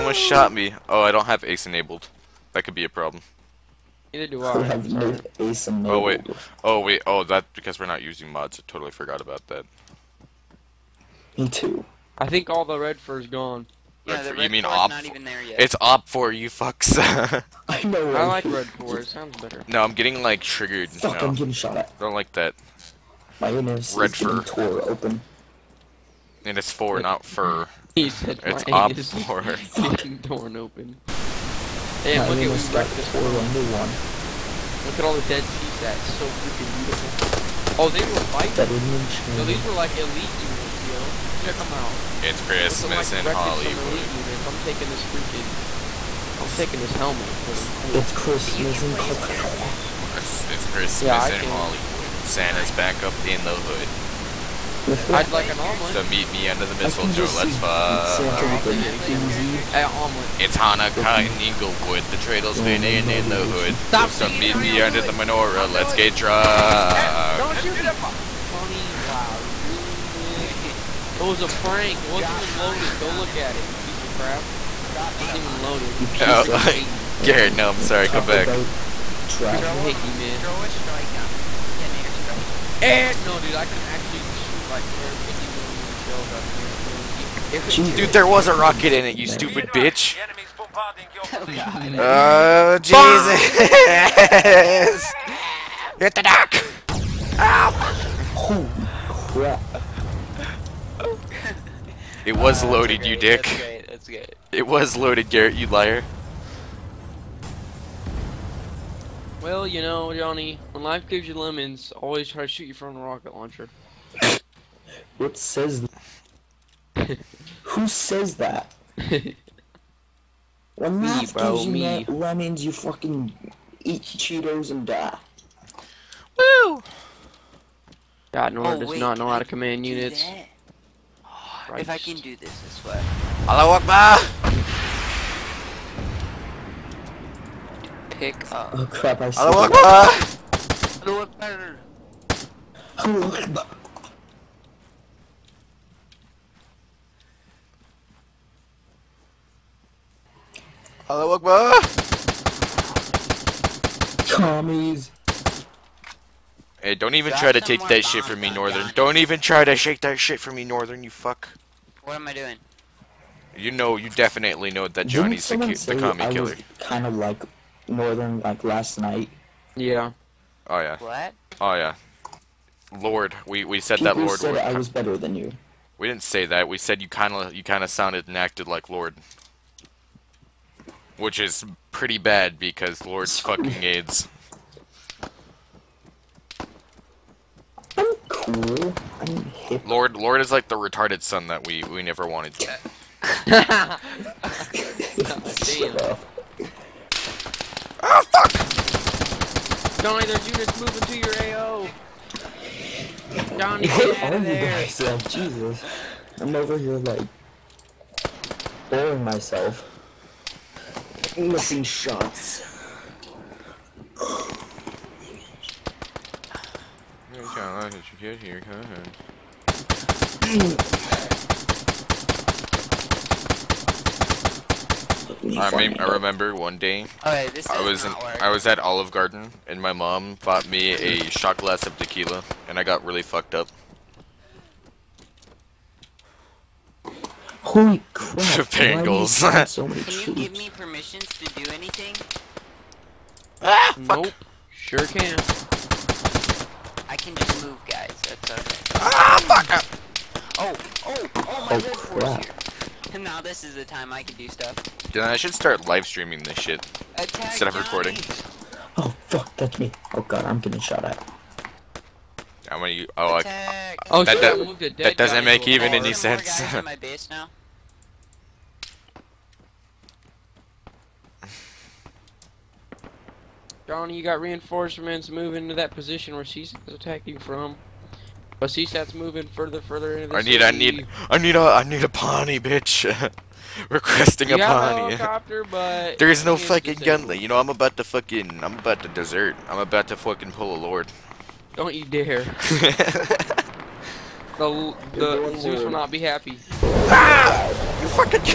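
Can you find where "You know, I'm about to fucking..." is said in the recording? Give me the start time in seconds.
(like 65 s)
287 s.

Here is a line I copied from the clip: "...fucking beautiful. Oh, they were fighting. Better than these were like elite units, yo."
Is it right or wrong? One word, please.
wrong.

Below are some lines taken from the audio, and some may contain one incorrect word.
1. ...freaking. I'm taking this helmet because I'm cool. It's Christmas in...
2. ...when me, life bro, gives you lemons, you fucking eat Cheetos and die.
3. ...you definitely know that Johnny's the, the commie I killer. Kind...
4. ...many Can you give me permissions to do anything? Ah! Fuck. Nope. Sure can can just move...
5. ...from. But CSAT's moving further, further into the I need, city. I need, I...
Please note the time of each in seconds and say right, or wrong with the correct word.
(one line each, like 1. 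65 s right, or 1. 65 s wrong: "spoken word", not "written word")
1. 45 s right
2. 120 s right
3. 163 s right
4. 239 s right
5. 277 s right.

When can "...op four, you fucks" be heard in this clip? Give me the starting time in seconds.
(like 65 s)
15 s.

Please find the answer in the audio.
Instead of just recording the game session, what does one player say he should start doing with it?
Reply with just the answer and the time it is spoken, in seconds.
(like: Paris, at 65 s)
live streaming, at 255 s.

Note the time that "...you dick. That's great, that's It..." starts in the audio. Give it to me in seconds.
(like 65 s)
103 s.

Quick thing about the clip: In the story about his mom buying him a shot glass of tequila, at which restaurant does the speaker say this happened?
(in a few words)
Olive Garden.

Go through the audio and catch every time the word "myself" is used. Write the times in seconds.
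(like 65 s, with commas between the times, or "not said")
204 s, 209 s.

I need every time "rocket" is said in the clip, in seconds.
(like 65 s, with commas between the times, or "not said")
88 s, 113 s.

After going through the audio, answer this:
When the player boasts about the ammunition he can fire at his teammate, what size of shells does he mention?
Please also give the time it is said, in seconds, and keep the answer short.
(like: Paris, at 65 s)
150 millimeter, at 84 s.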